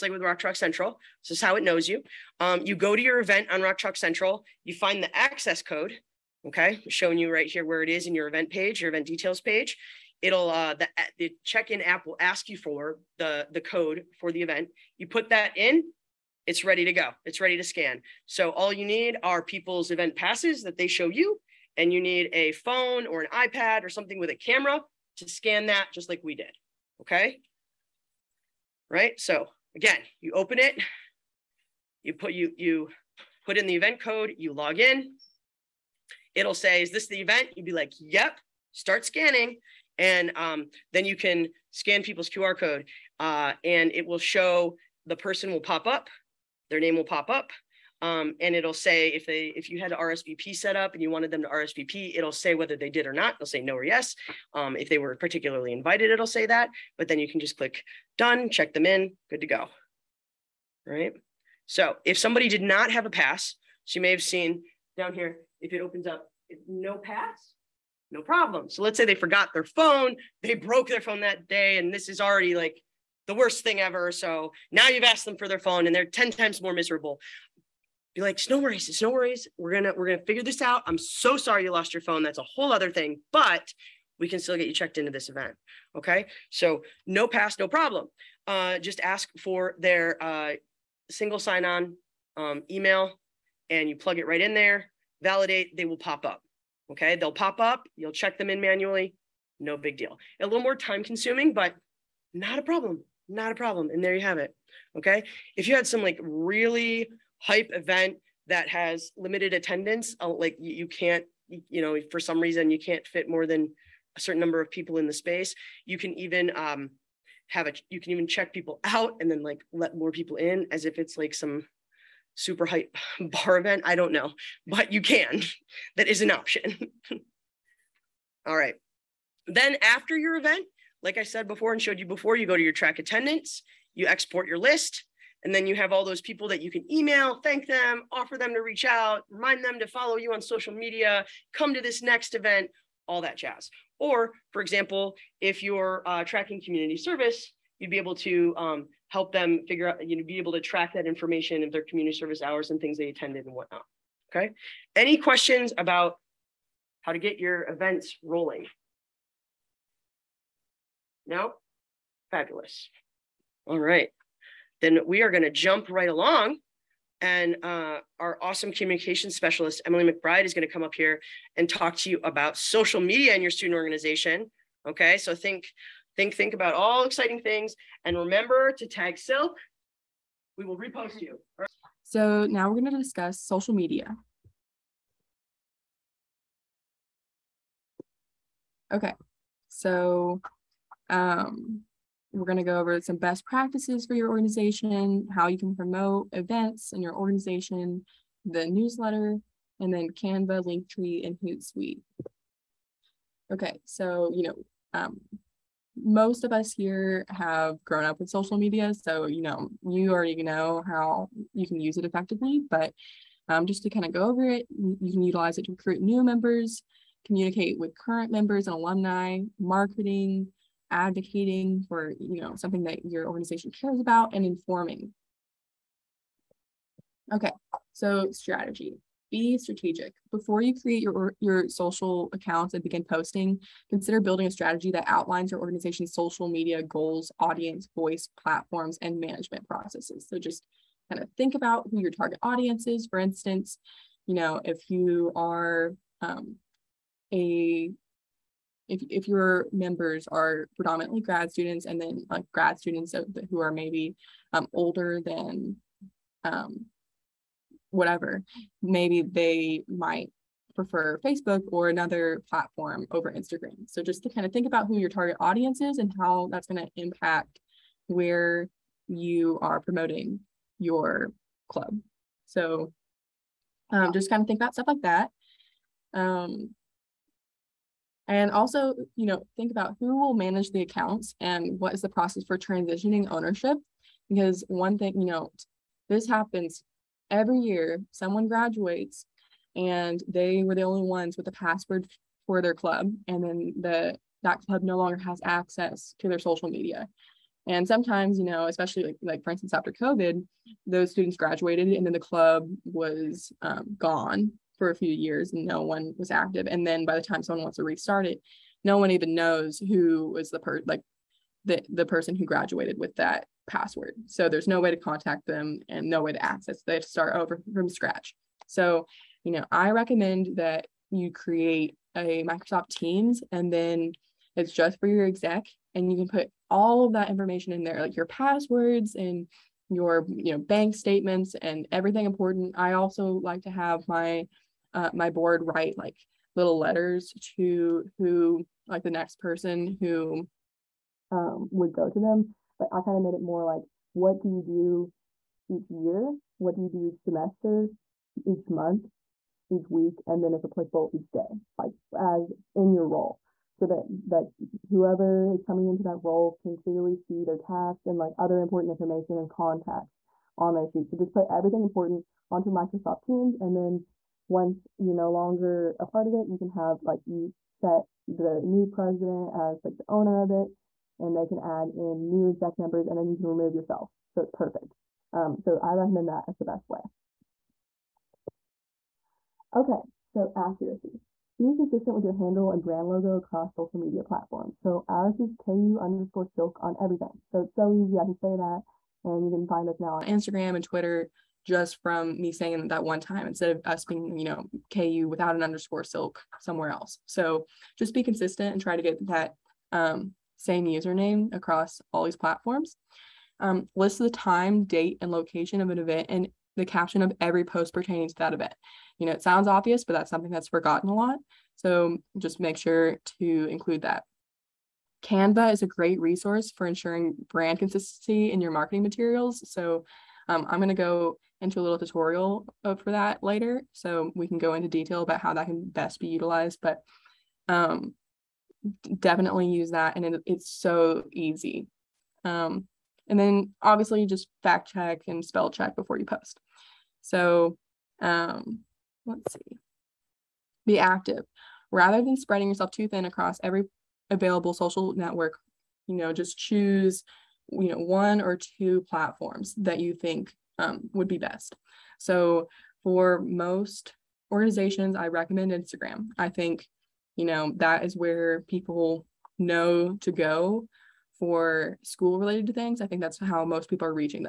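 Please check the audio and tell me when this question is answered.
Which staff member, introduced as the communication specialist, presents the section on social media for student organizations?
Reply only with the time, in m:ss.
2:49.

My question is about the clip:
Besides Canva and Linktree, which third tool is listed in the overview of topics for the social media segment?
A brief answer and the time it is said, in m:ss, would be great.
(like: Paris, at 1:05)
Hootsuite, at 3:21.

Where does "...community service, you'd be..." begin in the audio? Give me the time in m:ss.
2:26.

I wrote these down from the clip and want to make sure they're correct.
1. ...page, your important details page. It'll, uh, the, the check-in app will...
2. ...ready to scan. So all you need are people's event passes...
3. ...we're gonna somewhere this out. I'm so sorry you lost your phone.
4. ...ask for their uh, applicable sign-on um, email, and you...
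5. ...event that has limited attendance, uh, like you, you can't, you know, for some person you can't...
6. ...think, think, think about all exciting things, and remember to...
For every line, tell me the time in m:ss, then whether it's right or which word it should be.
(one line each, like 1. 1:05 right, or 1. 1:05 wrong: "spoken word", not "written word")
1. 0:08 wrong: "event", not "important"
2. 0:17 right
3. 1:19 wrong: "figure", not "somewhere"
4. 1:29 wrong: "single", not "applicable"
5. 1:47 wrong: "reason", not "person"
6. 2:55 right.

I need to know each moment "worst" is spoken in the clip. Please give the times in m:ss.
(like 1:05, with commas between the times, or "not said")
1:13.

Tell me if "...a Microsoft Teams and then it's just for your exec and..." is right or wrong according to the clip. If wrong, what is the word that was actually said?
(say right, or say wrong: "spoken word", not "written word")
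right.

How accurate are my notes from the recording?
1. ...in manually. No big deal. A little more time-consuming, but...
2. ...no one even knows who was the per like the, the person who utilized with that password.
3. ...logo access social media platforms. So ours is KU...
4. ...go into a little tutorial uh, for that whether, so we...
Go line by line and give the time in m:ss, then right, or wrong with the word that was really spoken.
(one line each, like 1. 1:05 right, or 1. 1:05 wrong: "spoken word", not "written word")
1. 1:38 right
2. 5:08 wrong: "graduated", not "utilized"
3. 6:23 wrong: "across", not "access"
4. 7:00 wrong: "later", not "whether".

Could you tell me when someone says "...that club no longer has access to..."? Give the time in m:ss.
4:54.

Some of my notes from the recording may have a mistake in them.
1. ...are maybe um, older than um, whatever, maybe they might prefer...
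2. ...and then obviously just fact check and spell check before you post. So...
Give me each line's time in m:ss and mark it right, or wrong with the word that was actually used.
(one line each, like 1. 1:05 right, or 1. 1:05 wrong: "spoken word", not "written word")
1. 4:13 right
2. 7:13 right.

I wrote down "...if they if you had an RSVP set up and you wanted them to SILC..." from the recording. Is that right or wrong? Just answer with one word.
wrong.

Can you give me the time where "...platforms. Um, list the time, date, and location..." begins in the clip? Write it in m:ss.
6:42.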